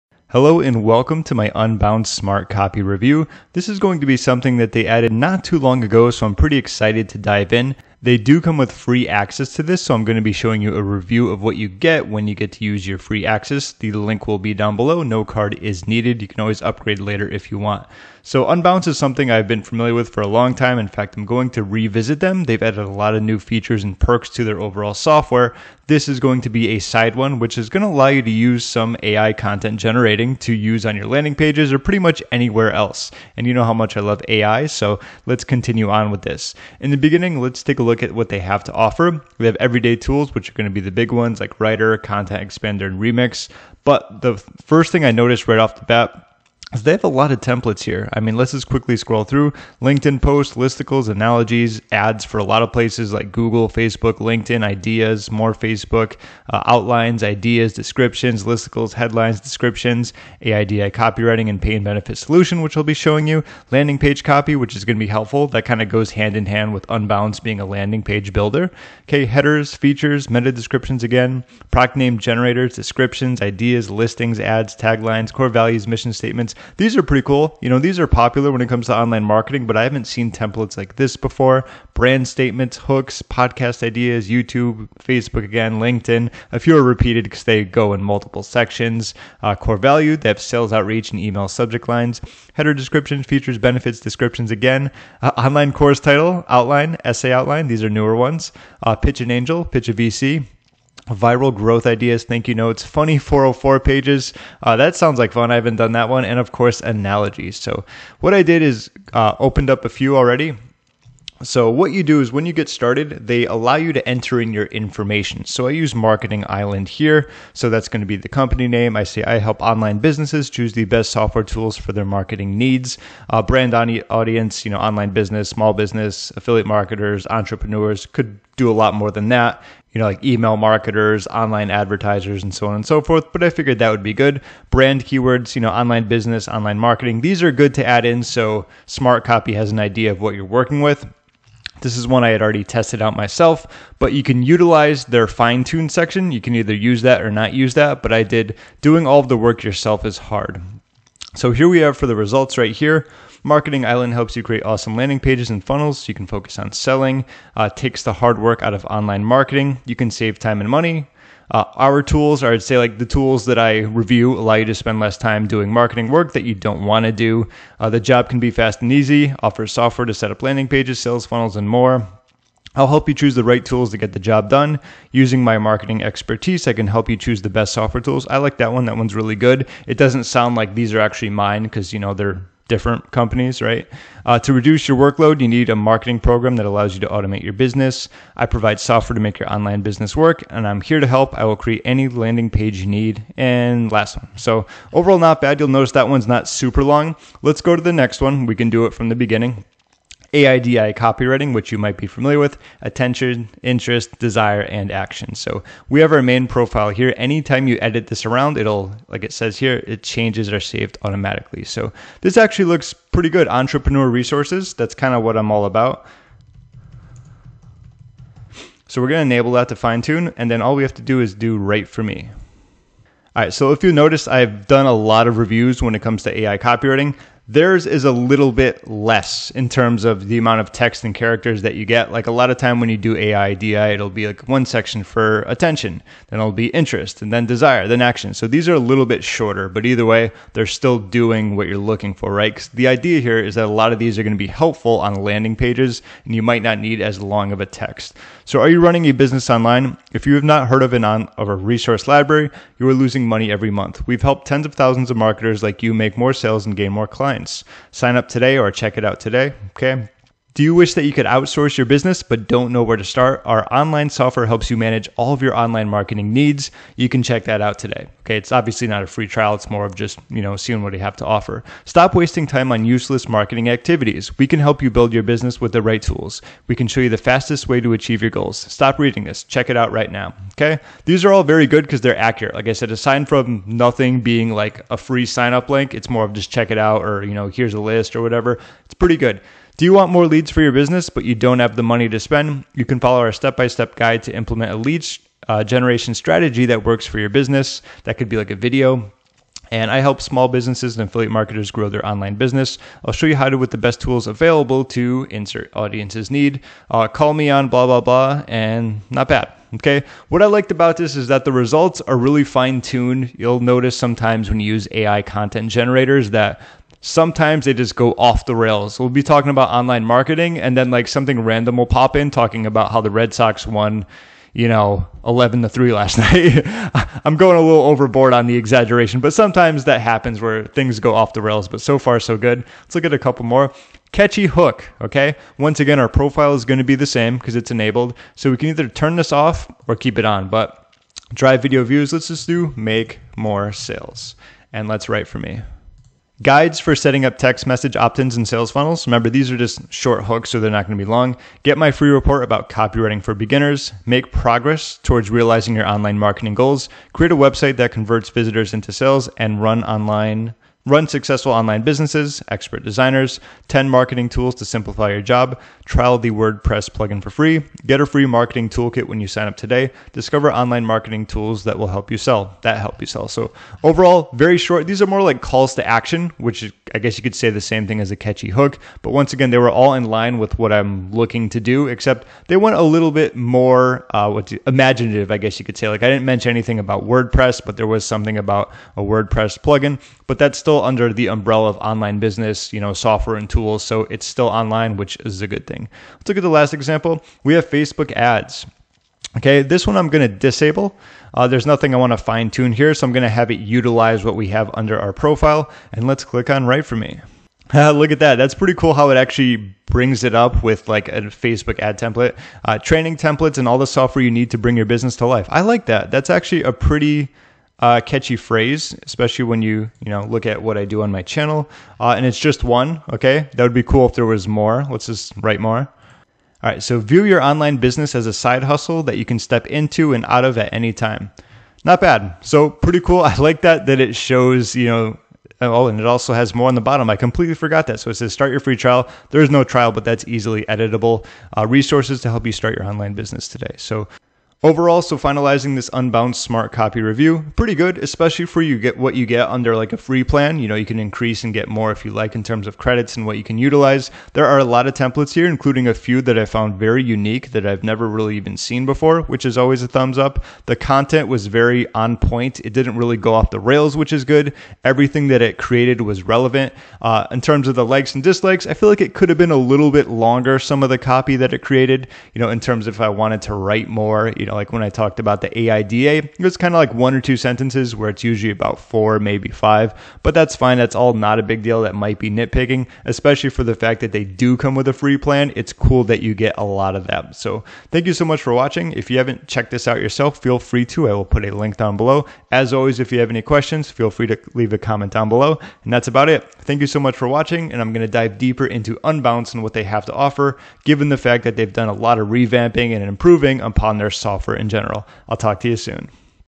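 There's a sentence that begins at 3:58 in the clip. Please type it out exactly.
So these are a little bit shorter, but either way, they're still doing what you're looking for, right?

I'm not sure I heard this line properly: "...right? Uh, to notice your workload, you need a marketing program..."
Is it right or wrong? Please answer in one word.
wrong.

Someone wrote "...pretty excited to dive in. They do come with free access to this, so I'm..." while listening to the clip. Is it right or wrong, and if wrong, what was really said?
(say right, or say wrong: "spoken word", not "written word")
right.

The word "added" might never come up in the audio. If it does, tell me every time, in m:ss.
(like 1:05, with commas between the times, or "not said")
0:04, 0:22.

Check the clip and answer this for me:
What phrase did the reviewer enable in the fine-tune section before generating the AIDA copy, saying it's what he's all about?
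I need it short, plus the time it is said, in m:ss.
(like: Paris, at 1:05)
Entrepreneur resources, at 3:33.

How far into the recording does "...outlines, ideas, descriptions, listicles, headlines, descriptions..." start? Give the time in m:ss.
0:56.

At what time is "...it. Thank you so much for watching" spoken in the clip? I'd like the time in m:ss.
8:16.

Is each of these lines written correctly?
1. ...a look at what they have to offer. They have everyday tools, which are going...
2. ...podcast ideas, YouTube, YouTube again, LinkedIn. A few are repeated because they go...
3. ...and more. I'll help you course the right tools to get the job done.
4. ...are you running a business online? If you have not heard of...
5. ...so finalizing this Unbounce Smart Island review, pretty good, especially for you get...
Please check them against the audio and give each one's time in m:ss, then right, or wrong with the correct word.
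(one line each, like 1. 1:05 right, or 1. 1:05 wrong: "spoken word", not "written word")
1. 0:37 right
2. 1:23 wrong: "Facebook", not "YouTube"
3. 2:51 wrong: "choose", not "course"
4. 4:08 right
5. 7:25 wrong: "Copy", not "Island".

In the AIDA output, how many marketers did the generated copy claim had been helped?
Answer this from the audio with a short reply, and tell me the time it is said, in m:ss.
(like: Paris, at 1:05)
tens of thousands, at 4:14.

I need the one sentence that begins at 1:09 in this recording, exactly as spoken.
Okay, headers, features, meta descriptions again, product name generators, descriptions, ideas, listings, ads, taglines, core values, mission statements these are pretty cool.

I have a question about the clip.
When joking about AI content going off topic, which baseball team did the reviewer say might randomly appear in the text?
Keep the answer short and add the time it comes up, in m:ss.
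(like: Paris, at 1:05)
Red Sox, at 5:23.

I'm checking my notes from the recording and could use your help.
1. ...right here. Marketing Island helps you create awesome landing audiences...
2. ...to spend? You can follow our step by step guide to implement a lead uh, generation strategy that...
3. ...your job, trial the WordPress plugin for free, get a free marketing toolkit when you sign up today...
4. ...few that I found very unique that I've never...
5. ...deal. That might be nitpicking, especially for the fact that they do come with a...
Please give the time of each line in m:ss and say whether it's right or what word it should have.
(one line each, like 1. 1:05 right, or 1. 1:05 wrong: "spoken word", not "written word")
1. 2:32 wrong: "pages", not "audiences"
2. 4:52 right
3. 6:05 right
4. 7:35 right
5. 8:01 right.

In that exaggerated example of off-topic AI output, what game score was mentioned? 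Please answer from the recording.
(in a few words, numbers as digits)
11 to 3.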